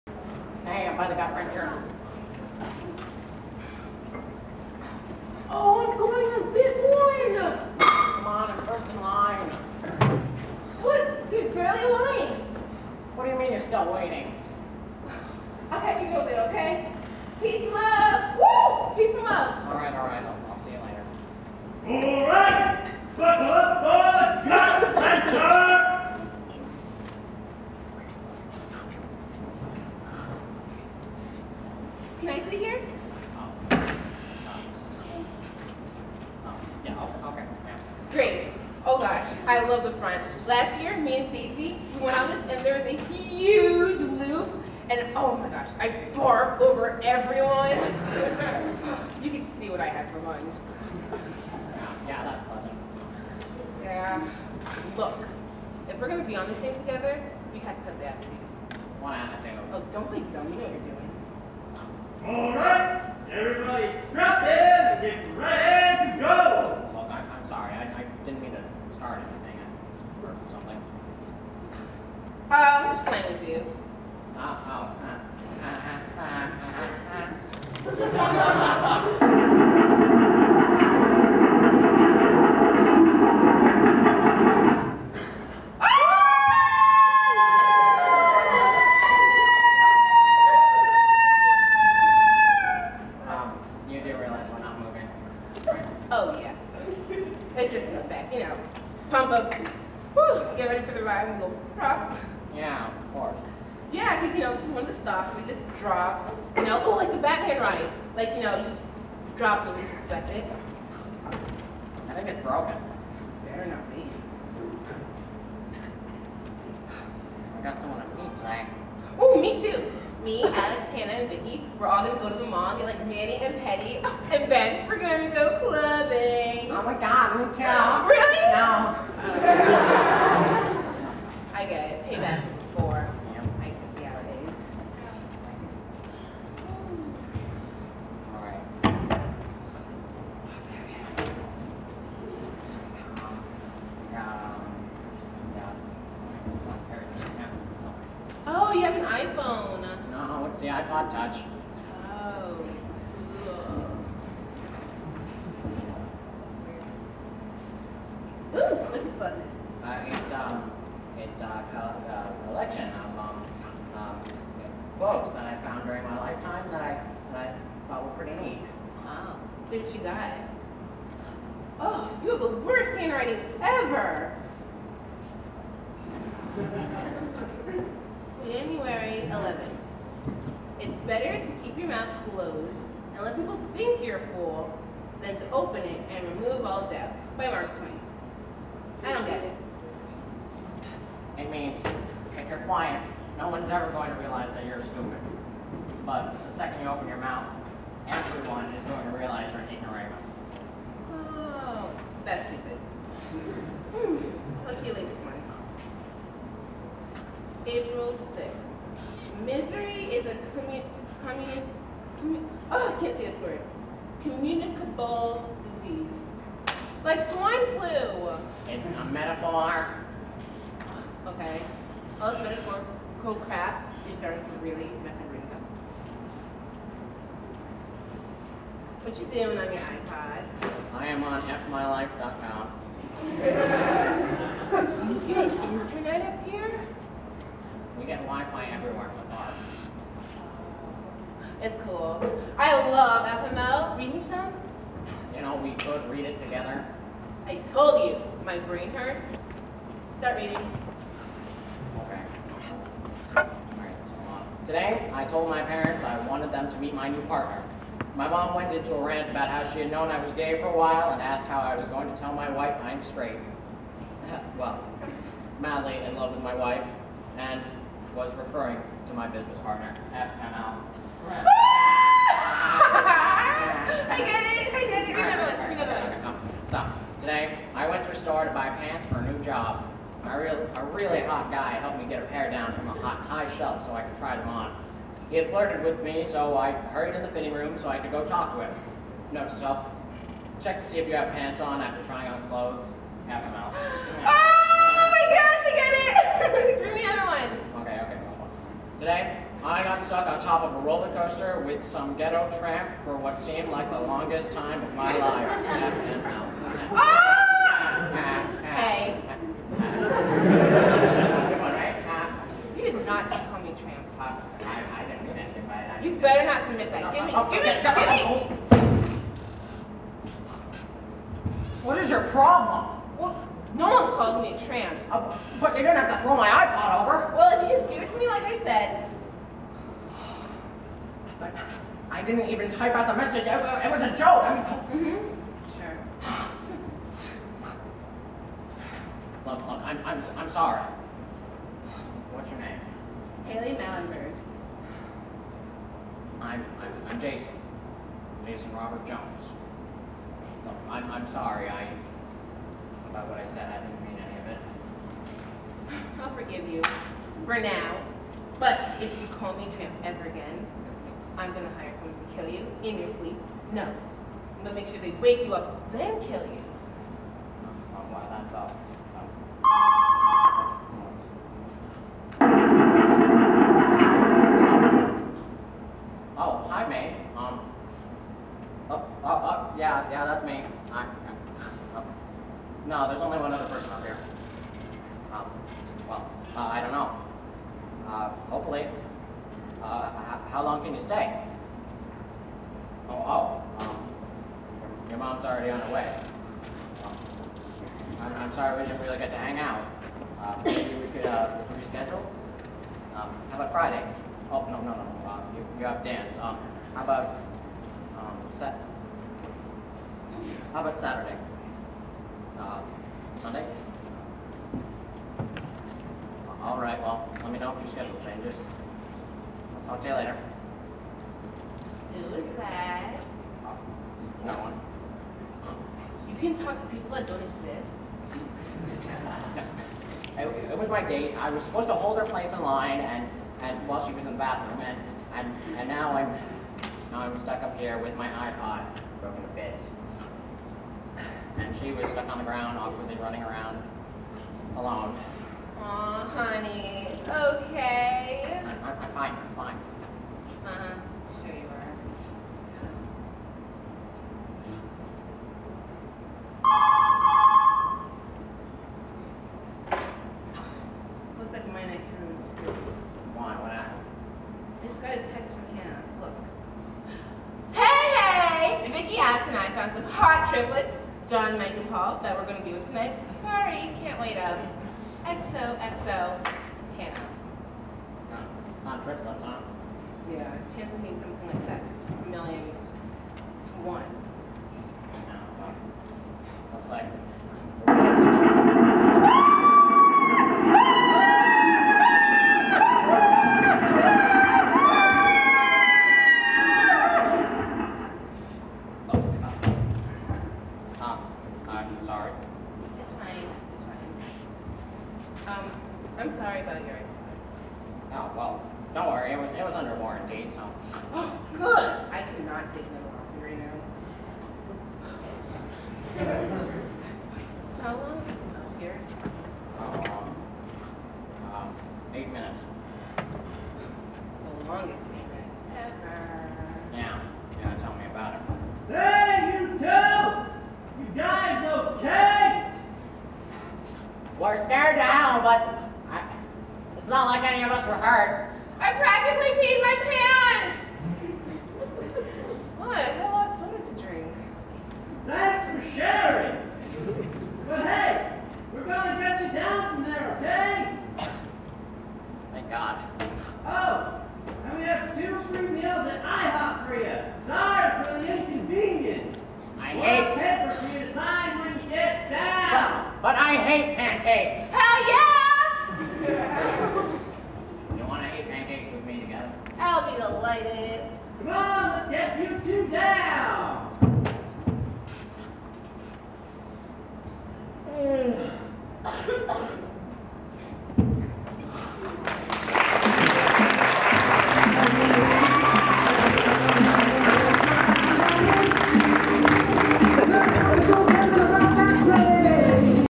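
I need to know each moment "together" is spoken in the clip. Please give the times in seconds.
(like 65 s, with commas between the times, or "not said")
56 s, 246 s.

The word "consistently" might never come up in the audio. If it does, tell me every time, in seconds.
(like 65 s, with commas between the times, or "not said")
not said.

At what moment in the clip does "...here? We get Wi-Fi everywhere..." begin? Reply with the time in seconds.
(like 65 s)
236 s.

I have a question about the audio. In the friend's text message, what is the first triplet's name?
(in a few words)
John.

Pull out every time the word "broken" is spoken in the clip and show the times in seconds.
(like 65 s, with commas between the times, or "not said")
112 s, 439 s.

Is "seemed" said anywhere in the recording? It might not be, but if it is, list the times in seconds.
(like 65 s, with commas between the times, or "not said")
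303 s.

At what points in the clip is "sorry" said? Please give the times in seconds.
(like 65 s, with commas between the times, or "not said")
340 s, 351 s, 398 s, 473 s, 502 s, 506 s.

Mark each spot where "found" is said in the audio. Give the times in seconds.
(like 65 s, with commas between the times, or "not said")
165 s, 469 s.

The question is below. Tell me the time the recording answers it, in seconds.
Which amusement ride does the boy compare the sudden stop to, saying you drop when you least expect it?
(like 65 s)
107 s.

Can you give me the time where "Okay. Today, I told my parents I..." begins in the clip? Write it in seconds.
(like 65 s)
251 s.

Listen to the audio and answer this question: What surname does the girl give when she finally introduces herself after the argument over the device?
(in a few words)
Mallenberg.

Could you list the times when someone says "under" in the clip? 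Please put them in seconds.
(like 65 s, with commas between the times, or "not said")
509 s.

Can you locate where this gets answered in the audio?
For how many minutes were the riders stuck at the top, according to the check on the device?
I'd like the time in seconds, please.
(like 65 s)
522 s.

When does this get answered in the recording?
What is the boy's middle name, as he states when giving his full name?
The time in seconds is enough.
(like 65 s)
348 s.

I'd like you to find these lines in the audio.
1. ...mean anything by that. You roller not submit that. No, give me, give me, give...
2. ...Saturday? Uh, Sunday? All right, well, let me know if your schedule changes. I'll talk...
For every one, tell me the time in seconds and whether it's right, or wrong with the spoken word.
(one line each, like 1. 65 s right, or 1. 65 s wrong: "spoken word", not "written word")
1. 315 s wrong: "better", not "roller"
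2. 411 s right.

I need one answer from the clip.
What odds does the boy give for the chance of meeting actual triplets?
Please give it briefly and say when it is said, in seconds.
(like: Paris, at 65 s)
a million to one, at 482 s.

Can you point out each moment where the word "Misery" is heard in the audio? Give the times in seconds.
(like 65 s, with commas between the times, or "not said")
209 s.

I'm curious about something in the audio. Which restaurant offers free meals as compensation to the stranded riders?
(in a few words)
IHOP.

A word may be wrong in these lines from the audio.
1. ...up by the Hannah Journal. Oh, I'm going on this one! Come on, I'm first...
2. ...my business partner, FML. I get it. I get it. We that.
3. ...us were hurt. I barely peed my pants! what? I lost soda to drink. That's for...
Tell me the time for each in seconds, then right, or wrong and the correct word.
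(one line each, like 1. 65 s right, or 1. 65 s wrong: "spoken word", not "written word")
1. 0 s wrong: "Godfriend", not "Hannah"
2. 269 s right
3. 537 s wrong: "practically", not "barely".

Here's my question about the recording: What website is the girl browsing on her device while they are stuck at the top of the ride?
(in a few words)
fmylife.com.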